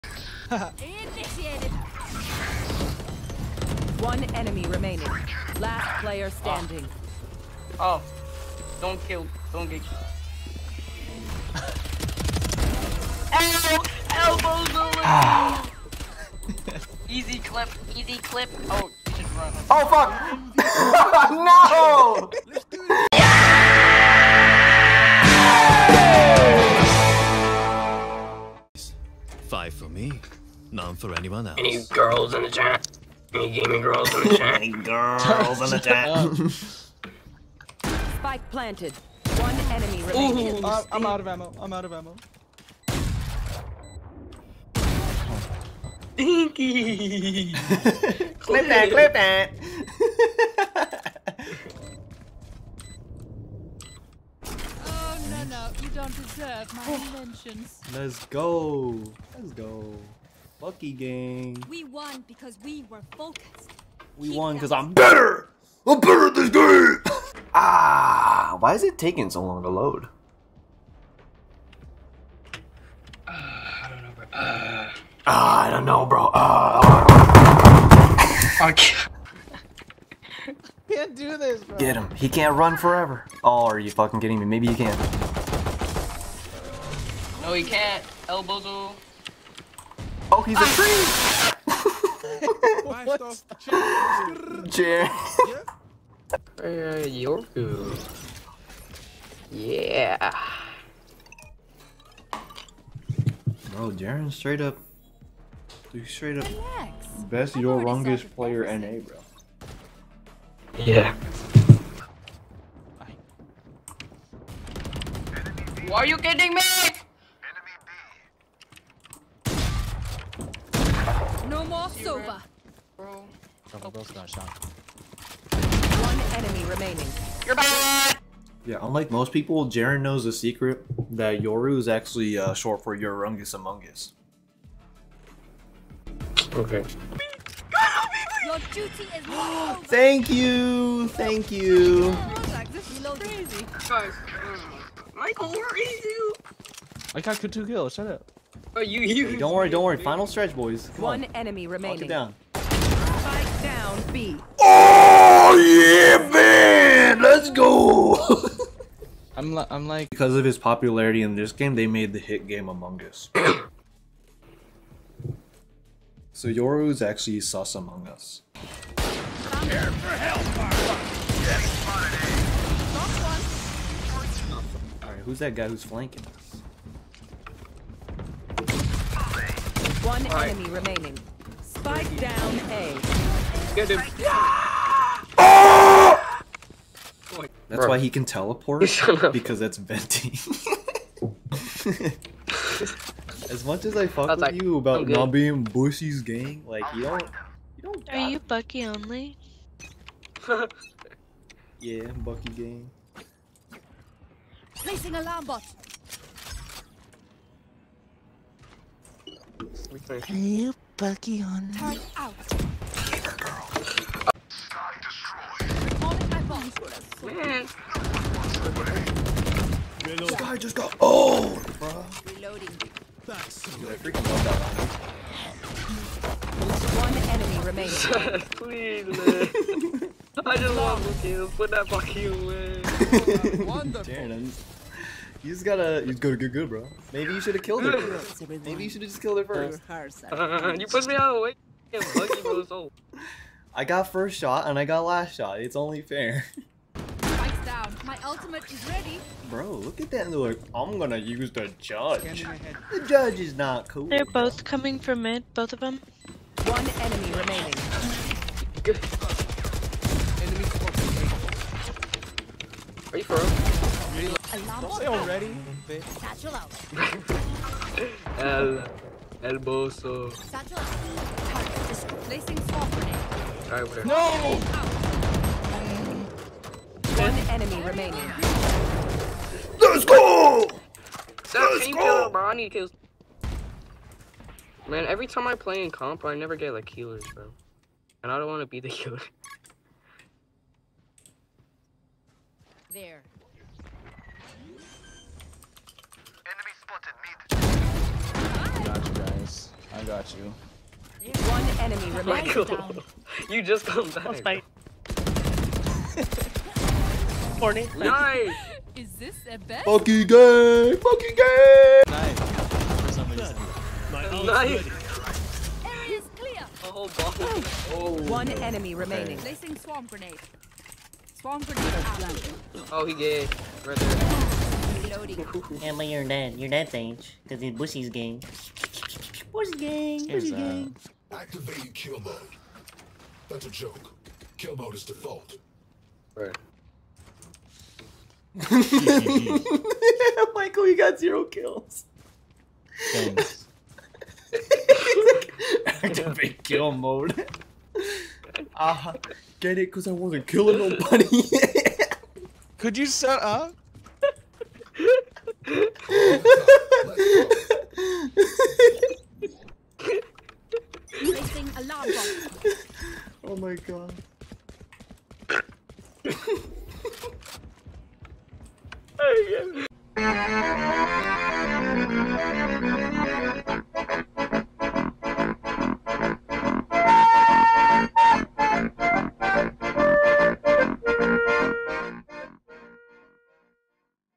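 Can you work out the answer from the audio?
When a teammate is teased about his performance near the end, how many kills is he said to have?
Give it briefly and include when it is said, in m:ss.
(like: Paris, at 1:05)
0, at 5:41.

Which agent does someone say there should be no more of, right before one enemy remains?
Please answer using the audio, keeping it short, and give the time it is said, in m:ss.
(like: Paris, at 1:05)
Sova, at 2:01.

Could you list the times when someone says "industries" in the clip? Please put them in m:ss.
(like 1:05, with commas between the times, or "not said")
not said.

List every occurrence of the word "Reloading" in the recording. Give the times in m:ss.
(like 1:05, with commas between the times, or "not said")
3:42, 5:25.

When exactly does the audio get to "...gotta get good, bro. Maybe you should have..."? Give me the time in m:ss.
3:56.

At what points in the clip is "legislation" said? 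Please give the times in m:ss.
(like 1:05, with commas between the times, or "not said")
not said.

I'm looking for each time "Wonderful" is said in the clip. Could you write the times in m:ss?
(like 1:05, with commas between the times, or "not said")
3:53.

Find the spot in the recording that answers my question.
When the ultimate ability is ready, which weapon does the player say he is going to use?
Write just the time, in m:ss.
4:10.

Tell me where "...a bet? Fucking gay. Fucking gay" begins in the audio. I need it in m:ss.
5:09.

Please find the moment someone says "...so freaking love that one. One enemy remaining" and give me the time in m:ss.
3:43.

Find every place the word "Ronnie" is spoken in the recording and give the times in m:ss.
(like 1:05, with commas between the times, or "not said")
4:42.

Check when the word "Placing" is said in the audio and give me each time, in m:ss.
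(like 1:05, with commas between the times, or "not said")
3:24, 5:19.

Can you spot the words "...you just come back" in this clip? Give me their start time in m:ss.
5:03.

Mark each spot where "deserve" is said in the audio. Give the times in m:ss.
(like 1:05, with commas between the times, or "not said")
0:56.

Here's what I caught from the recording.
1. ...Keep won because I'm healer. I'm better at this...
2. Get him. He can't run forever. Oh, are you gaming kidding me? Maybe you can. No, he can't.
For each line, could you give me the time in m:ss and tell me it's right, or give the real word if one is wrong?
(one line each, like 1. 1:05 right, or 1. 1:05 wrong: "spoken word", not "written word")
1. 1:04 wrong: "better", not "healer"
2. 1:21 wrong: "fucking", not "gaming".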